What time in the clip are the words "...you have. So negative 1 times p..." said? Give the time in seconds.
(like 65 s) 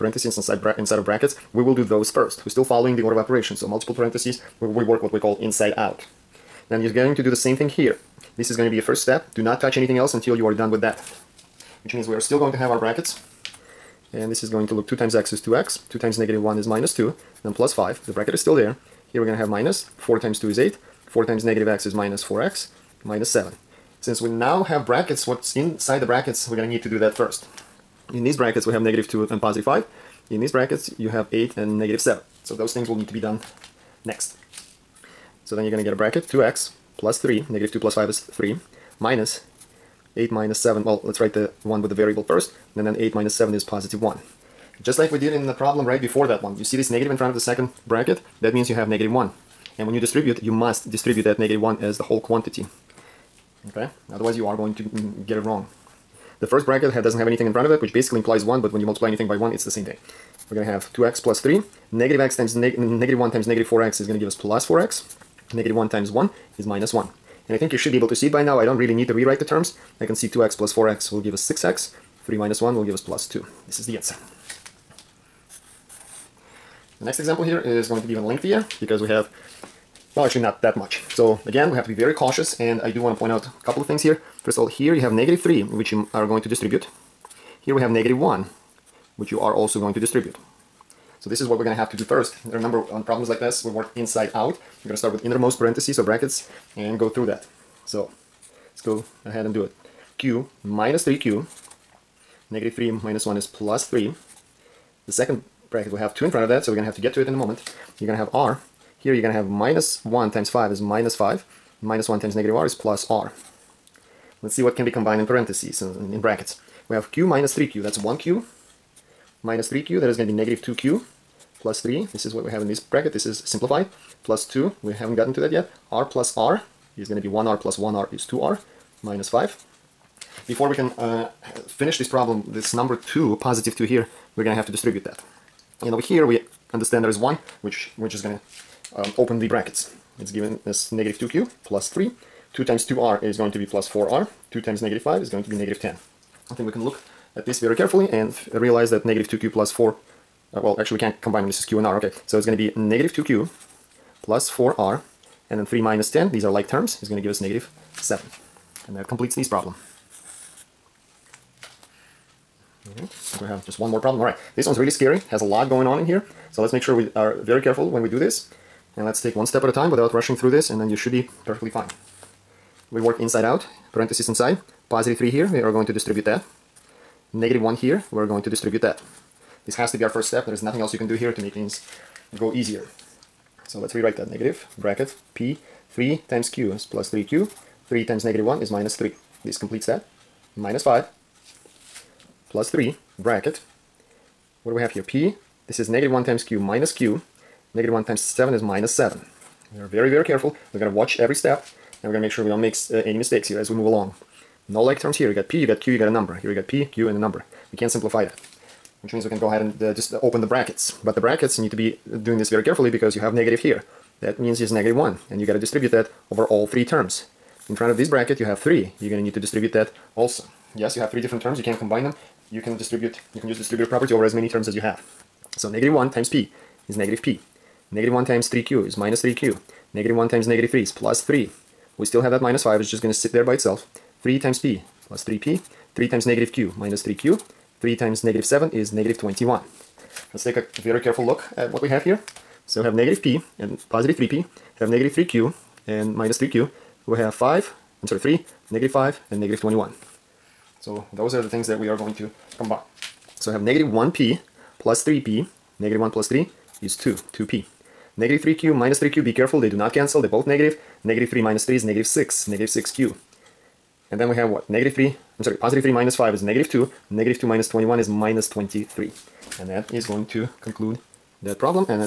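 224 s.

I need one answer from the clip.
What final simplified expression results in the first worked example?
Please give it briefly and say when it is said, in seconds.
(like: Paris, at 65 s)
6x + 2, at 71 s.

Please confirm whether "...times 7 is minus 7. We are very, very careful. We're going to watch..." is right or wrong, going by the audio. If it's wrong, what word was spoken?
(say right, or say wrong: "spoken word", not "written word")
right.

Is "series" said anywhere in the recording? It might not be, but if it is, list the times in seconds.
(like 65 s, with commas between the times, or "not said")
not said.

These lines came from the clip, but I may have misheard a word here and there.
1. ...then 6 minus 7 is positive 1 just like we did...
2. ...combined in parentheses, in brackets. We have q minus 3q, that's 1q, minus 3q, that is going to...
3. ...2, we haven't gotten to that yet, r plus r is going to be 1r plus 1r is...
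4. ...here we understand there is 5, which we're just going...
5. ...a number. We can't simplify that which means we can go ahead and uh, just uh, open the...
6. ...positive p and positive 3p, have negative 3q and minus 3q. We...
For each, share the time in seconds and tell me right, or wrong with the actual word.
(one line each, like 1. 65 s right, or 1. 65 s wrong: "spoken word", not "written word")
1. 42 s wrong: "8", not "6"
2. 114 s right
3. 124 s right
4. 135 s wrong: "1", not "5"
5. 207 s right
6. 242 s wrong: "negative", not "positive".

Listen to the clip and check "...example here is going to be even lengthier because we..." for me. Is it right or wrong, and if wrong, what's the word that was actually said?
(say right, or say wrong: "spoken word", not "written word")
right.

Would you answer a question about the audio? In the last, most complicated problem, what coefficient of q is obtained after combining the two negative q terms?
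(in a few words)
-6.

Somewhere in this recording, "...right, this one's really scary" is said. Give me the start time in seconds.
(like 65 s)
164 s.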